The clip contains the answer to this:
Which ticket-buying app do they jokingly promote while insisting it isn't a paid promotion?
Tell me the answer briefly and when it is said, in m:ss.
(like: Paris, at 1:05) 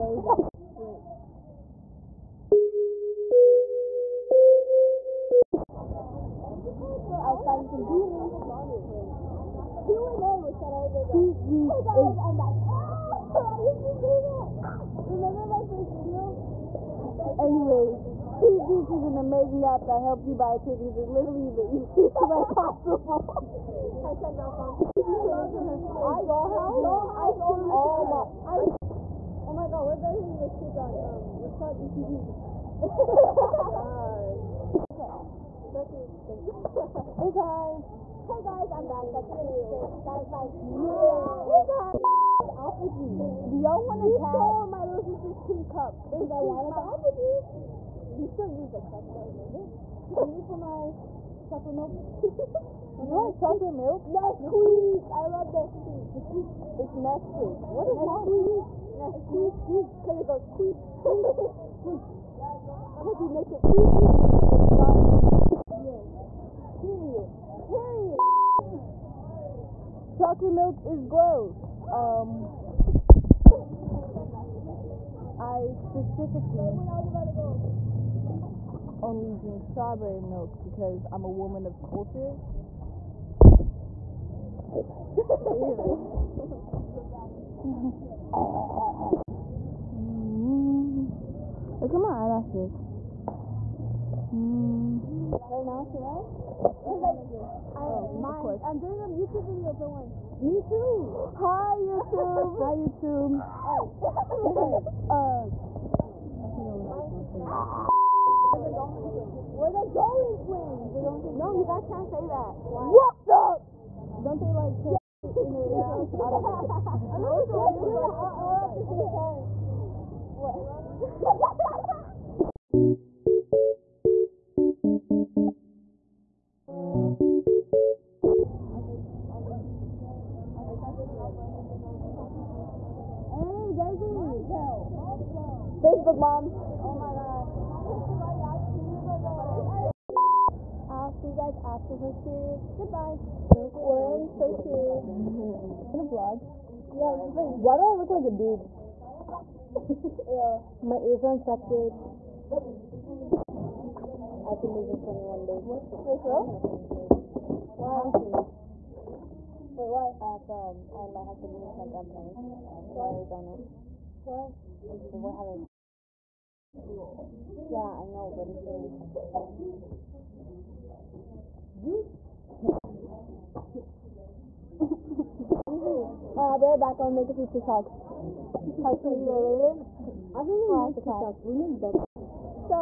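SeatGeek, at 0:18.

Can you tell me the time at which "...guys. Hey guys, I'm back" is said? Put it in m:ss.
0:37.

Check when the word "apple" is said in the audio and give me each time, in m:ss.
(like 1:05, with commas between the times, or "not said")
0:42, 0:46.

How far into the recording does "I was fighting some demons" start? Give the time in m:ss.
0:07.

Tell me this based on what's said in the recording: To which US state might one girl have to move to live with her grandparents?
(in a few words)
Arizona.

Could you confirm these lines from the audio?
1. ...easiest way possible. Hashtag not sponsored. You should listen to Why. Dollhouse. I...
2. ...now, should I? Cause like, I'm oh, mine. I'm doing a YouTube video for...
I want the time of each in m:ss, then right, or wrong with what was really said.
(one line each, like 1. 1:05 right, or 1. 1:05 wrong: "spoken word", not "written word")
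1. 0:21 wrong: "Dollhouse", not "Why"
2. 1:35 right.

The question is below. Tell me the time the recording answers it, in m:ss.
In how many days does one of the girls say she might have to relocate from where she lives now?
2:34.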